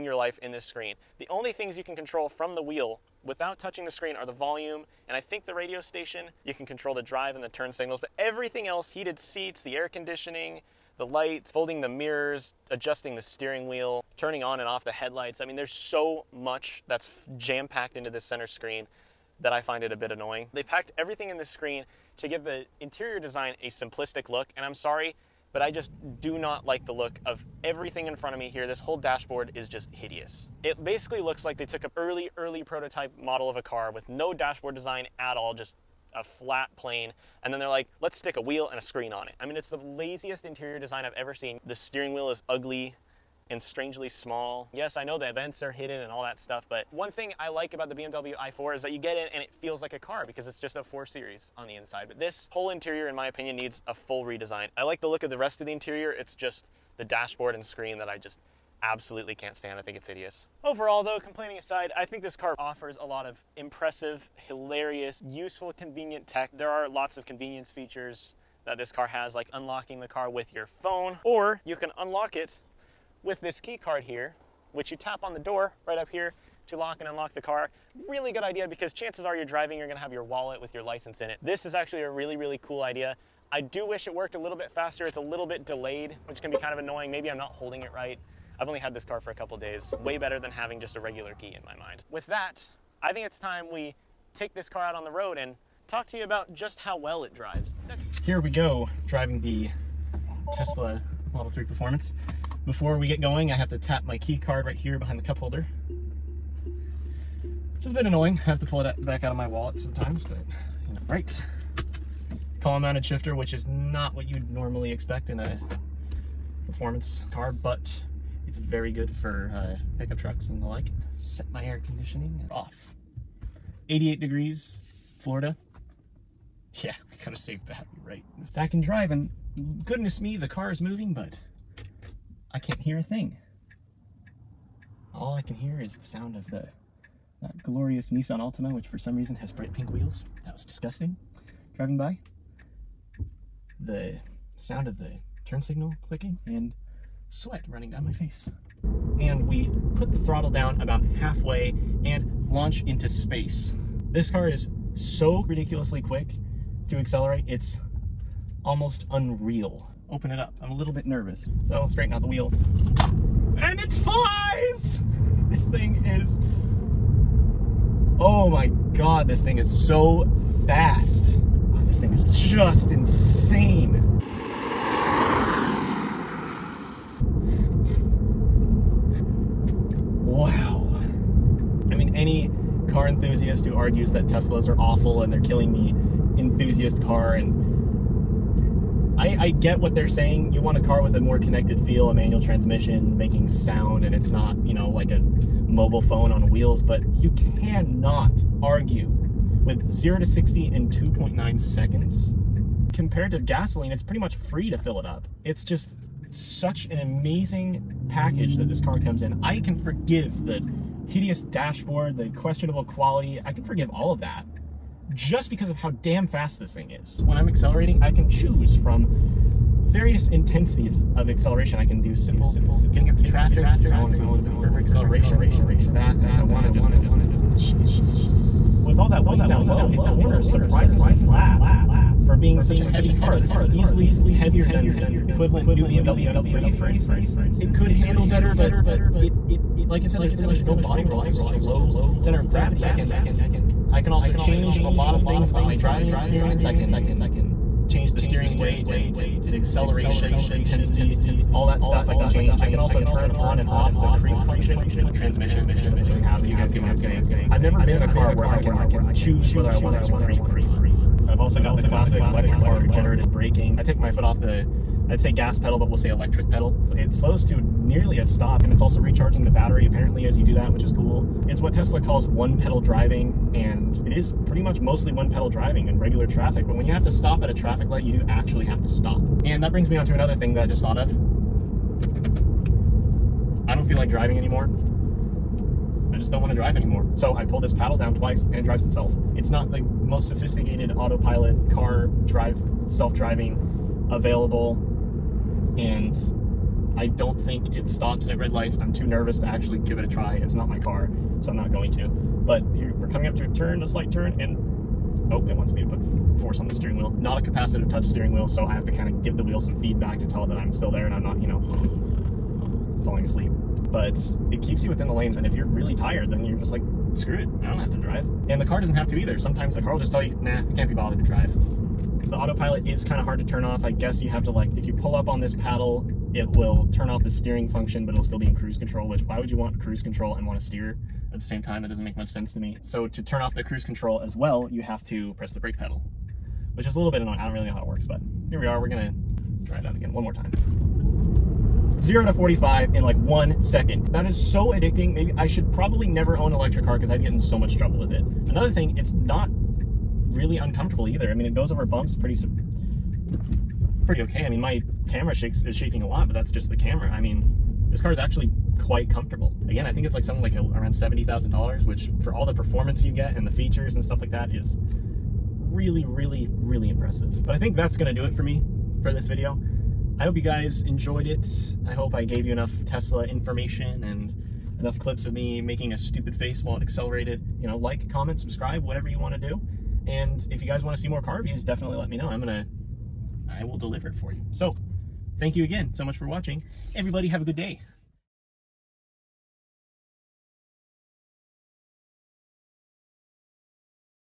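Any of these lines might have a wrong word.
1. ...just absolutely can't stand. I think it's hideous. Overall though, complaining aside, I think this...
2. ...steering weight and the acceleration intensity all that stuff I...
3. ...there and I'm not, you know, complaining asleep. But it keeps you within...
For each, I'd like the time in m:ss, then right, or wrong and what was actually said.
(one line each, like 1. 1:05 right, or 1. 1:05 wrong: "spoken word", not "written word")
1. 0:58 right
2. 4:08 right
3. 5:10 wrong: "falling", not "complaining".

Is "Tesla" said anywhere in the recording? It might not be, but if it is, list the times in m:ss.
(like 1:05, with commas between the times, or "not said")
1:40, 3:04, 4:31, 6:12.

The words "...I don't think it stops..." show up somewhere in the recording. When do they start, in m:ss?
4:57.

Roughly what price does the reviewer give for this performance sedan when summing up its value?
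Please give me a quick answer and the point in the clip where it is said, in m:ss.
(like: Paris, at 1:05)
$70,000, at 6:00.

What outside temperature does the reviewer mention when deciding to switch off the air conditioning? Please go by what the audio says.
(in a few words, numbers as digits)
88 degrees.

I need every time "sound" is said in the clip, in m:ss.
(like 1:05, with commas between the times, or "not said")
2:16, 2:24, 3:13.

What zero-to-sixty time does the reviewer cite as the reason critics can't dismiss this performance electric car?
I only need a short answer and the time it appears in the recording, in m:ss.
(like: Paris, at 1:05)
2.9 seconds, at 3:20.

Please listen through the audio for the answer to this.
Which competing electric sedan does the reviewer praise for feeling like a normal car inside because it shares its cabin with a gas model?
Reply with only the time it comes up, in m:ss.
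0:47.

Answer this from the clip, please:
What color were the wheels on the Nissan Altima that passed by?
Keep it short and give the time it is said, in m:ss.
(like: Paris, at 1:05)
bright pink, at 2:19.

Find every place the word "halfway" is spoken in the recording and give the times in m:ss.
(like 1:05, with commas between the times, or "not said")
2:31.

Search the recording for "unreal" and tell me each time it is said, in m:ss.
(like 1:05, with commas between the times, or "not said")
2:39.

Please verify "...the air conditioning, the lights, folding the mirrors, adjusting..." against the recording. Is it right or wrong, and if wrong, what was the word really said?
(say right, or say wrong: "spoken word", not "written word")
right.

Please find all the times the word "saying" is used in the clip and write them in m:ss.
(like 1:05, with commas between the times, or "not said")
3:10, 4:16.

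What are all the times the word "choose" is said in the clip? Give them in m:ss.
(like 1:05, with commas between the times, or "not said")
3:38, 4:19.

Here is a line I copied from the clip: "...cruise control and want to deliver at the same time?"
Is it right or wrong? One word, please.
wrong.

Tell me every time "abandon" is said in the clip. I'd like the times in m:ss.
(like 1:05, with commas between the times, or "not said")
not said.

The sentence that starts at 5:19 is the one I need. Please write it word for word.
Sometimes the car will just tell you, nah, I can't be bothered to drive.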